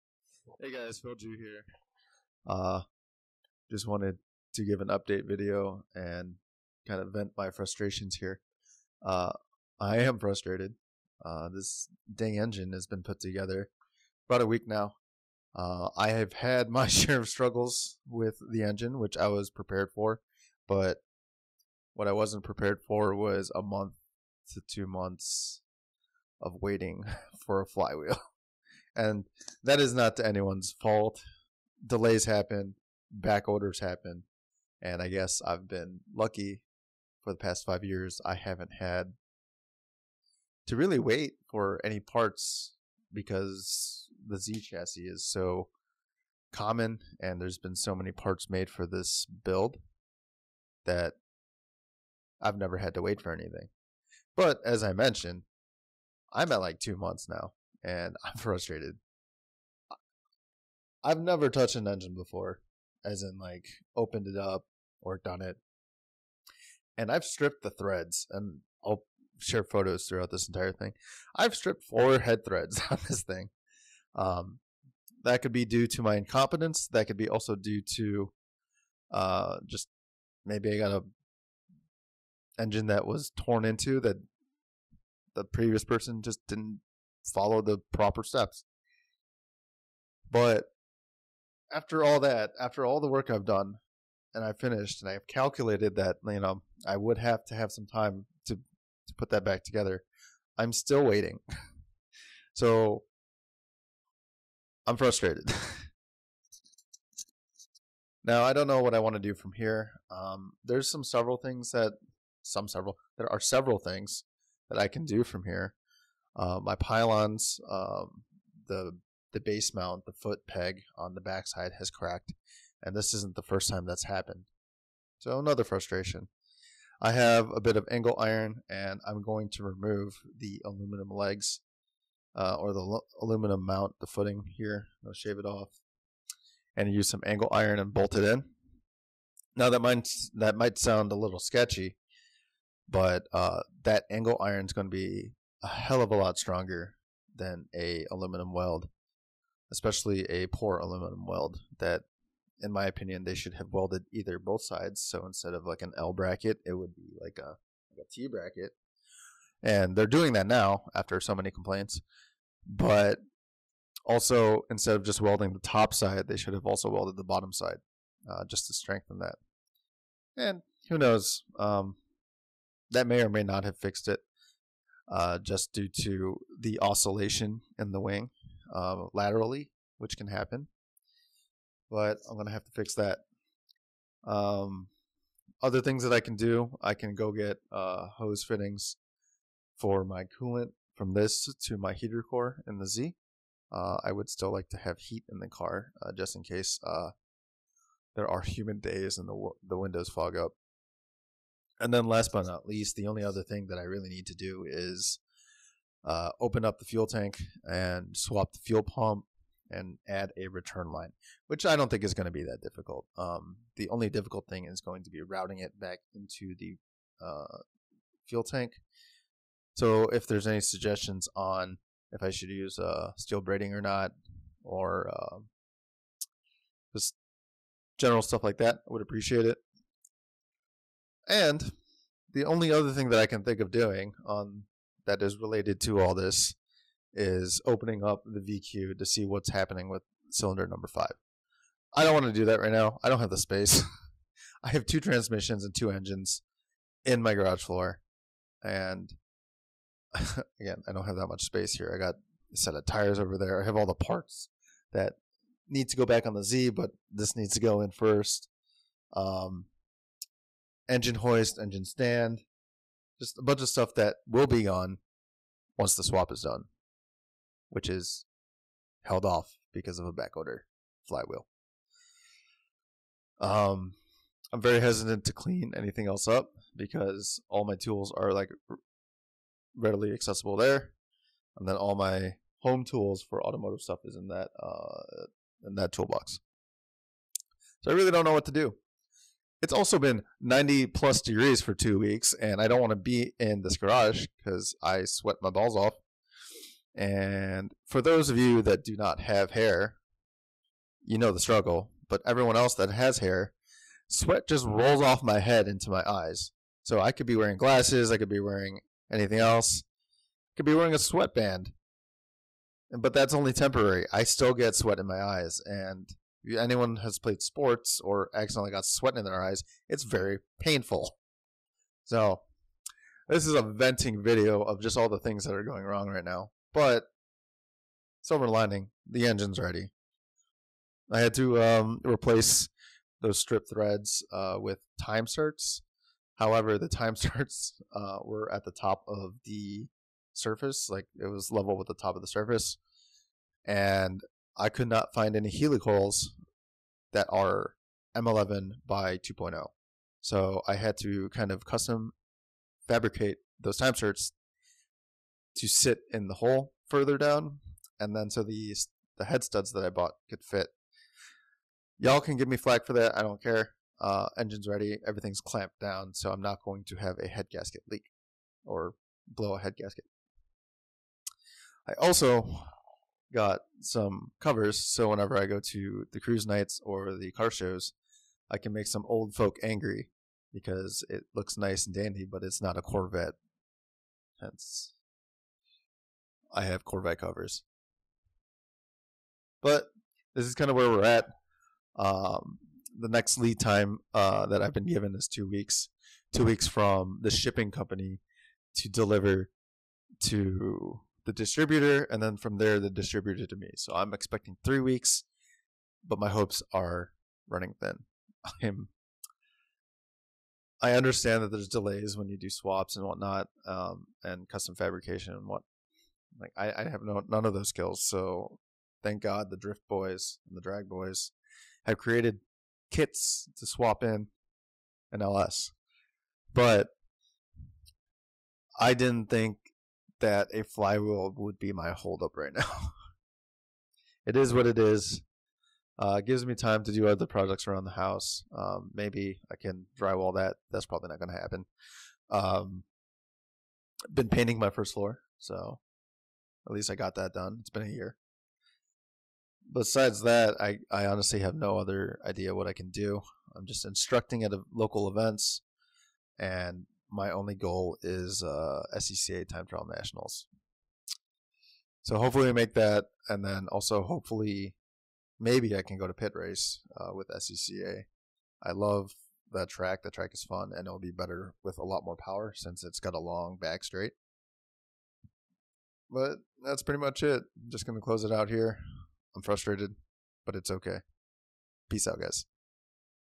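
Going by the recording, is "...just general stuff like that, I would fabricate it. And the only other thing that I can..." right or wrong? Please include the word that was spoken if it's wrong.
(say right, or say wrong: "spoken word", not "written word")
wrong: "appreciate", not "fabricate".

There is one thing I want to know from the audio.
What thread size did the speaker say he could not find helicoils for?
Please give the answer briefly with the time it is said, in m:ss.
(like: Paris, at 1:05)
M11 by 2.0, at 5:48.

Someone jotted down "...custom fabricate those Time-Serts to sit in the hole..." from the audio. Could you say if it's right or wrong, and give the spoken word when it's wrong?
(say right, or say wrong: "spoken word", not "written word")
right.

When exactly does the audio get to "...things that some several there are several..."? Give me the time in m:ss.
1:51.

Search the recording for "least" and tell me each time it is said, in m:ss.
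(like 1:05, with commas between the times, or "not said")
3:22, 7:26.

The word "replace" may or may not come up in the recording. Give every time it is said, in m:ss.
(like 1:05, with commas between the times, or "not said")
5:32.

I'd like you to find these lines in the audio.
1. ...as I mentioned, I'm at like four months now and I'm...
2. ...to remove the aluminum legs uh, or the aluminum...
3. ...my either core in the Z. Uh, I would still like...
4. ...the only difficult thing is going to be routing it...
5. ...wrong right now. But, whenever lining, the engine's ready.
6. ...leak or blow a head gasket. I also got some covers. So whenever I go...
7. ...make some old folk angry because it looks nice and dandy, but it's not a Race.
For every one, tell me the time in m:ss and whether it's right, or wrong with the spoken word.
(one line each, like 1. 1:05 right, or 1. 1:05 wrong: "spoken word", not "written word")
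1. 0:54 wrong: "two", not "four"
2. 2:09 right
3. 3:11 wrong: "heater", not "either"
4. 3:33 right
5. 5:25 wrong: "silver", not "whenever"
6. 6:07 right
7. 6:18 wrong: "Corvette", not "Race".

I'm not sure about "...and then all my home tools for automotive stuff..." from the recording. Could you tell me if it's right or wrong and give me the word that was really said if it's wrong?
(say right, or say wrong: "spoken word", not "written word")
right.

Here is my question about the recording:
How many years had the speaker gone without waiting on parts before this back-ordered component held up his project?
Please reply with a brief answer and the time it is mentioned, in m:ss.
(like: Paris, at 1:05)
5, at 0:37.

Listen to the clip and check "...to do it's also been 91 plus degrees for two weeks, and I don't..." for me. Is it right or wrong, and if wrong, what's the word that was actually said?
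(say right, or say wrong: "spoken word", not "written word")
wrong: "90", not "91".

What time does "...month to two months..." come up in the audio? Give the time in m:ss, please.
0:23.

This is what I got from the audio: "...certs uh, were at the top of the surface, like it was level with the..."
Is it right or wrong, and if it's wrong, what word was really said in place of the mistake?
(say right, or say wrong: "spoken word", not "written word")
right.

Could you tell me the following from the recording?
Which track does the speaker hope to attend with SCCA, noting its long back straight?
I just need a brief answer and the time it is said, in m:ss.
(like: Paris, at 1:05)
Pitt Race, at 7:46.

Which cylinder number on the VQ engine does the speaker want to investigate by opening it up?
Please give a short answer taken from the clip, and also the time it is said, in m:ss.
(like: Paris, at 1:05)
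5, at 4:00.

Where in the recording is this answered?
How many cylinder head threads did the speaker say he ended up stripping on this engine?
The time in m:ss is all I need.
1:11.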